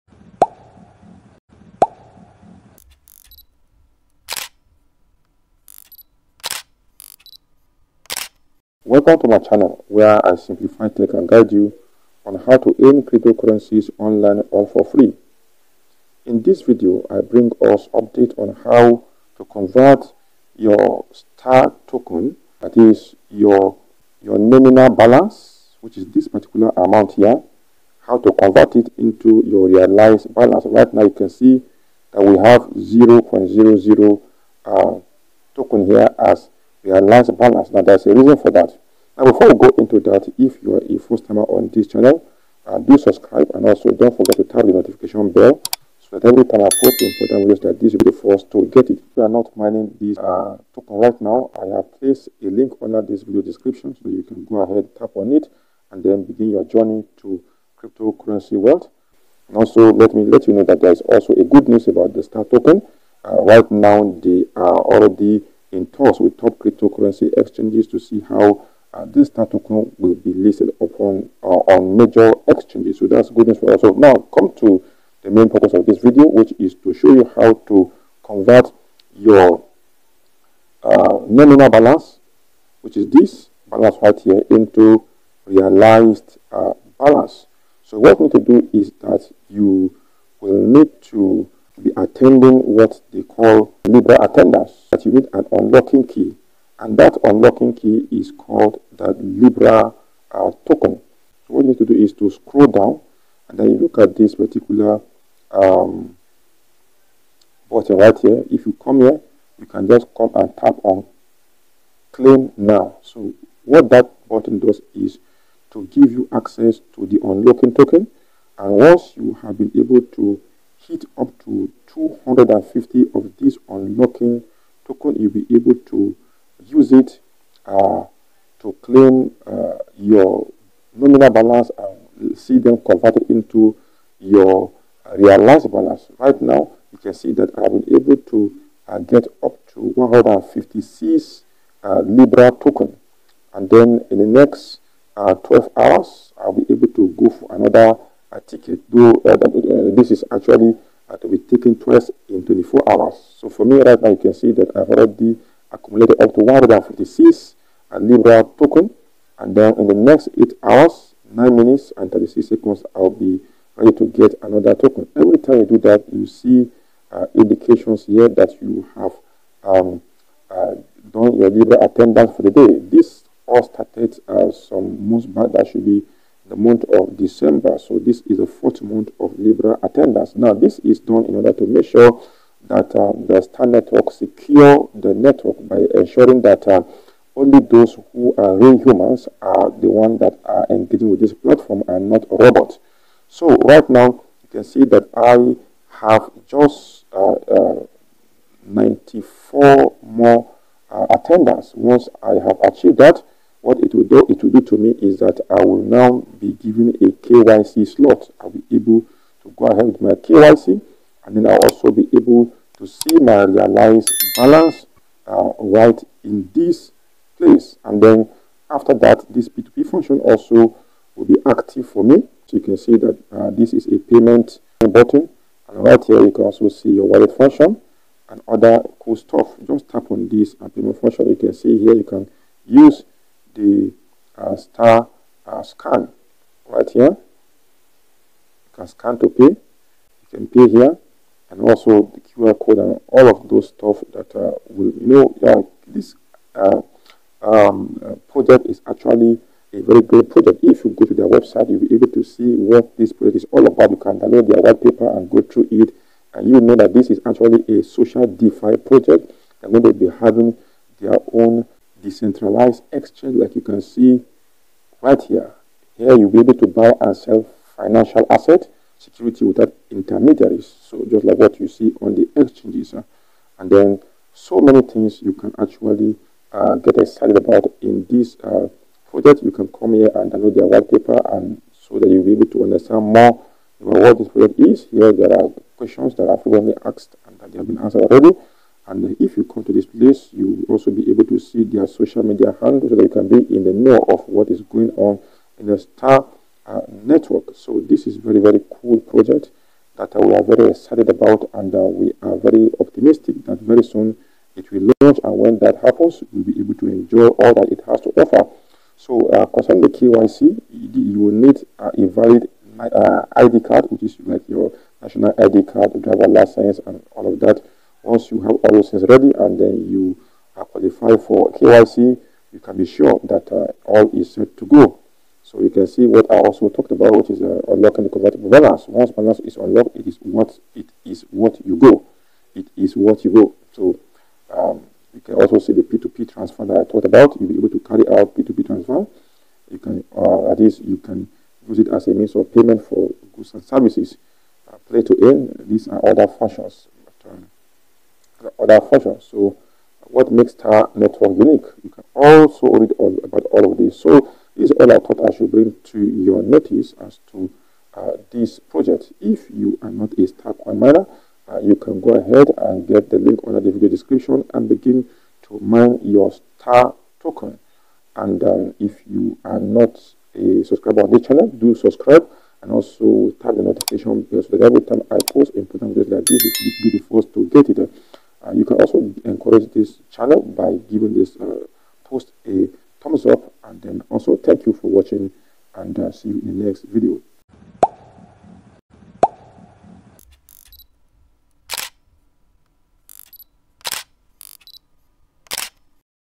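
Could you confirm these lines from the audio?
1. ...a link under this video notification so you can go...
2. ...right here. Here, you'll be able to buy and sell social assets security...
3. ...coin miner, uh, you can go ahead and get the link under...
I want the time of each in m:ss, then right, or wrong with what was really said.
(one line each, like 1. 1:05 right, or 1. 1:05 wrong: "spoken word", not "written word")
1. 0:52 wrong: "description", not "notification"
2. 4:25 wrong: "financial", not "social"
3. 6:00 right.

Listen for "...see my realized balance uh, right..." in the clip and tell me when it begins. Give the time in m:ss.
3:32.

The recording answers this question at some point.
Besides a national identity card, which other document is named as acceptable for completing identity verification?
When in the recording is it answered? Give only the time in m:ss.
5:16.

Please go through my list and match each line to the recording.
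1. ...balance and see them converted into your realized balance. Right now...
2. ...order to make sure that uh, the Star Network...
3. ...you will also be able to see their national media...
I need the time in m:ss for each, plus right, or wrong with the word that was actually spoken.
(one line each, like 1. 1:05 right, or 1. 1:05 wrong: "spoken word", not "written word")
1. 2:11 right
2. 3:01 right
3. 4:50 wrong: "social", not "national".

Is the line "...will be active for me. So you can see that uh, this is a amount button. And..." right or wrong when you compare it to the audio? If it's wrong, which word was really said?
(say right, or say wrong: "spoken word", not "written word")
wrong: "payment", not "amount".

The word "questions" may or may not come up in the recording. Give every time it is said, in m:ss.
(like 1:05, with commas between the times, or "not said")
4:45.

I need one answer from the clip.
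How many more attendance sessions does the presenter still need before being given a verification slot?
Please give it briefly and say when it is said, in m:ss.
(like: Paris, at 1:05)
94, at 3:18.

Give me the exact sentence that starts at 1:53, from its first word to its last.
So what that button does is to give you access to the unlocking token.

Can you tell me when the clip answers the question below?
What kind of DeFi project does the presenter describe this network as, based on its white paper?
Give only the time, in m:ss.
4:17.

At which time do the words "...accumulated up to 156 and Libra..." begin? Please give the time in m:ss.
2:35.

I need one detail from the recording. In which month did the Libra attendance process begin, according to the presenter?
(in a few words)
December.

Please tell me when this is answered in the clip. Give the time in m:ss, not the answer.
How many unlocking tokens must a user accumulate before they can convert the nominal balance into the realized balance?
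2:01.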